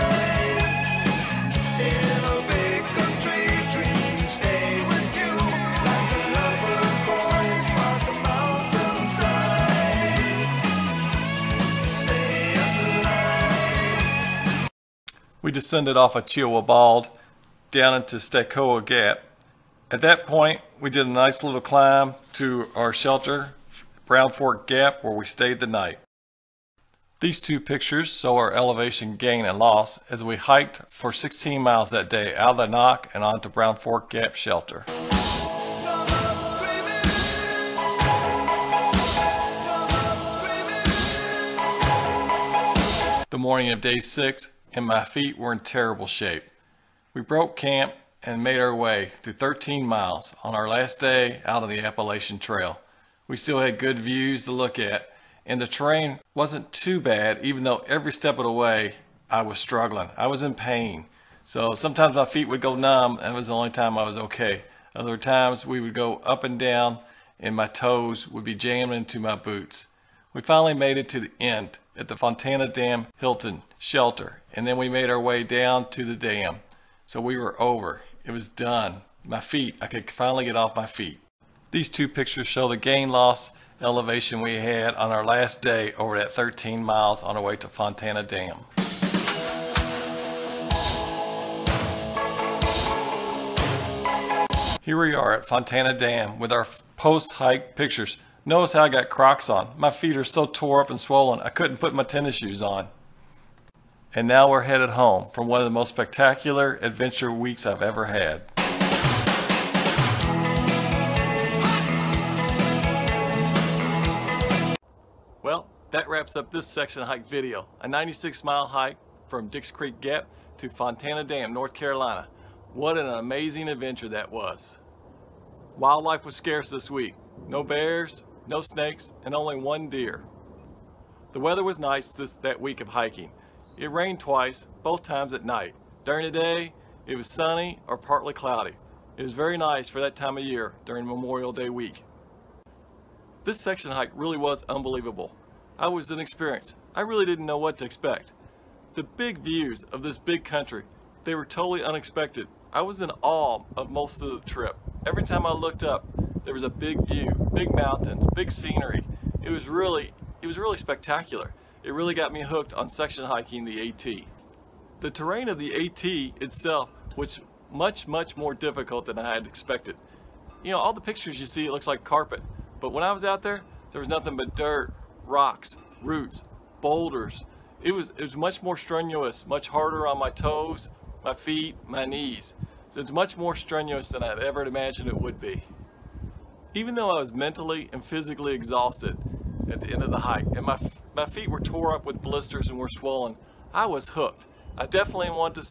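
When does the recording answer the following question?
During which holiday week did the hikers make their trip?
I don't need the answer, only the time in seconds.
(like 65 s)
141 s.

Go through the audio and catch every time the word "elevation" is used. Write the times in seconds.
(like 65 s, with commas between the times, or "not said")
28 s, 83 s.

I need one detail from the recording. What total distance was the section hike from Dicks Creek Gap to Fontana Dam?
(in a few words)
96 miles.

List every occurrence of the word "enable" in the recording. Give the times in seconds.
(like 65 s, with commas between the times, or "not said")
not said.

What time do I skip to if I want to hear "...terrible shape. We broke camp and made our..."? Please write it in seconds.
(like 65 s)
45 s.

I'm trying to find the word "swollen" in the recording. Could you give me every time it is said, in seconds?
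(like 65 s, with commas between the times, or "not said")
100 s, 192 s.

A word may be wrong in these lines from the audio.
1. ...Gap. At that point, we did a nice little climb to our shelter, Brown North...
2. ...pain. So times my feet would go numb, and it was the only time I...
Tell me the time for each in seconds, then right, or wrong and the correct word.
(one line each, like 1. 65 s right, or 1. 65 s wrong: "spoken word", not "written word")
1. 18 s wrong: "Fork", not "North"
2. 60 s wrong: "sometimes", not "times".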